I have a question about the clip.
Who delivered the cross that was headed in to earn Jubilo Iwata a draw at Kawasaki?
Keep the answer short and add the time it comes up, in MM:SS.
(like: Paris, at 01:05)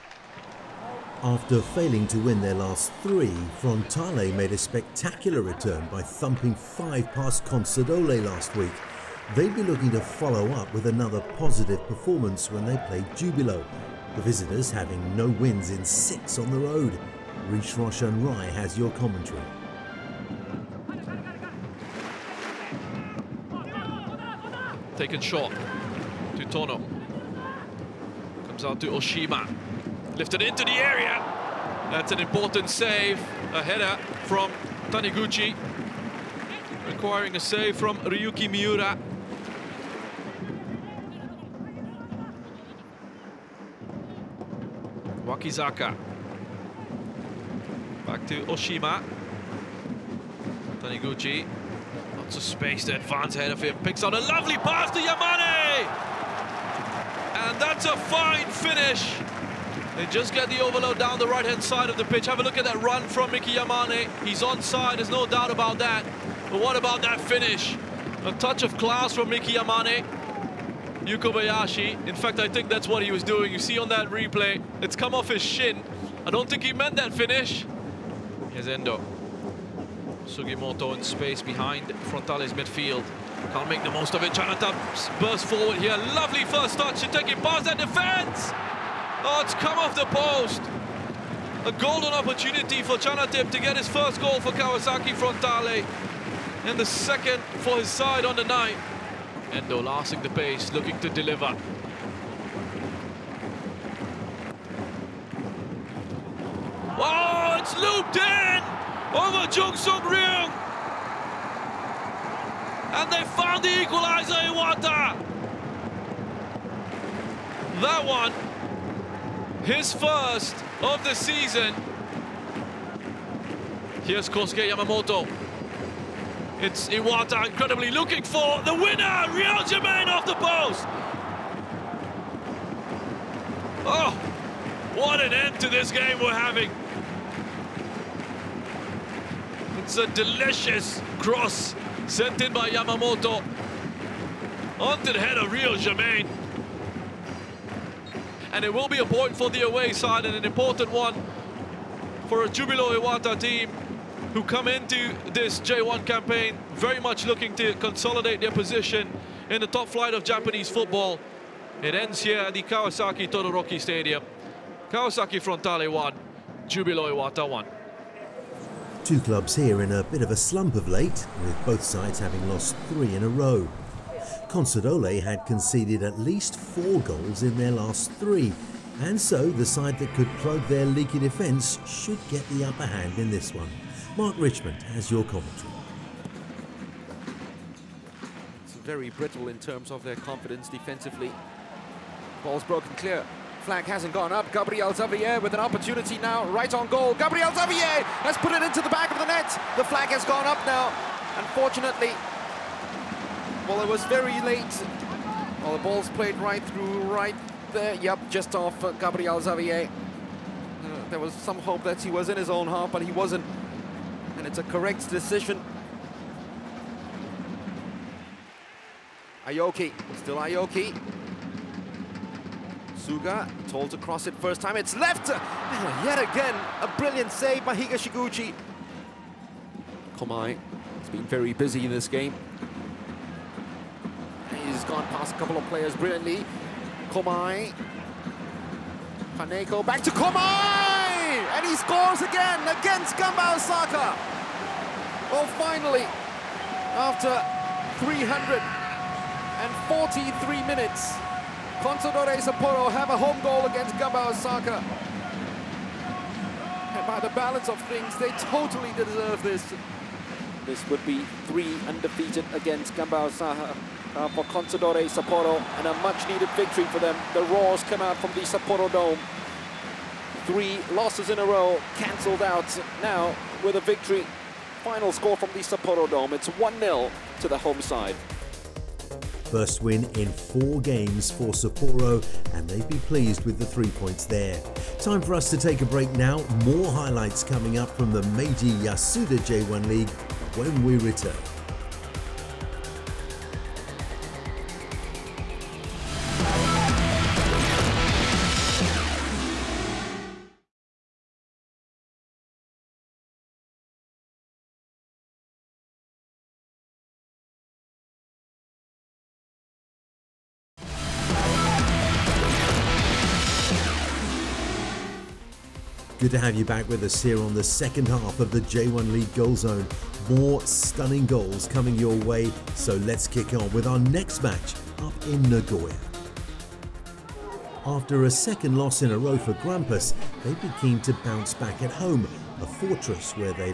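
Kosuke Yamamoto, at 02:04.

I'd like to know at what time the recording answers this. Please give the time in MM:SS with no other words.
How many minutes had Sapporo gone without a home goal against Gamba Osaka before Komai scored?
04:08.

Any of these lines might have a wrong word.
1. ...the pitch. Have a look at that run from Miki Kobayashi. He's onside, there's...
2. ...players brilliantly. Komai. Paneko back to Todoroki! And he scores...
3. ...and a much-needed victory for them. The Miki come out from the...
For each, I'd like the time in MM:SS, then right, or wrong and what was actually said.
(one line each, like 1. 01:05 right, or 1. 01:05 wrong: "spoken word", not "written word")
1. 01:01 wrong: "Yamane", not "Kobayashi"
2. 03:55 wrong: "Komai", not "Todoroki"
3. 04:25 wrong: "Roars", not "Miki".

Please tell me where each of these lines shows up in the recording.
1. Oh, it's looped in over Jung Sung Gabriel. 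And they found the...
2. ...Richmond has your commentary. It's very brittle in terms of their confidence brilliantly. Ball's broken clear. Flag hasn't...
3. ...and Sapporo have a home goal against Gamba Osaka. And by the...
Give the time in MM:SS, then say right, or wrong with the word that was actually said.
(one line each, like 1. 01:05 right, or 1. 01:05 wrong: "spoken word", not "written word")
1. 01:47 wrong: "Ryong", not "Gabriel"
2. 03:04 wrong: "defensively", not "brilliantly"
3. 04:11 right.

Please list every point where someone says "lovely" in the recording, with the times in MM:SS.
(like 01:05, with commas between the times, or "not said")
00:54, 01:26.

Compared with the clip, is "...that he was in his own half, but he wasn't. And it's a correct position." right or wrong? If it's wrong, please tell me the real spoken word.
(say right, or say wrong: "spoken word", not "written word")
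wrong: "decision", not "position".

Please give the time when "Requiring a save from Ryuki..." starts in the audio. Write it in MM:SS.
00:36.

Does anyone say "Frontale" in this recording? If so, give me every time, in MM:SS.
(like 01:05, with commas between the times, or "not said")
00:03, 01:22, 01:35, 02:45.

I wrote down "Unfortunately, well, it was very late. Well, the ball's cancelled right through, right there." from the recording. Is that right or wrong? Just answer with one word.
wrong.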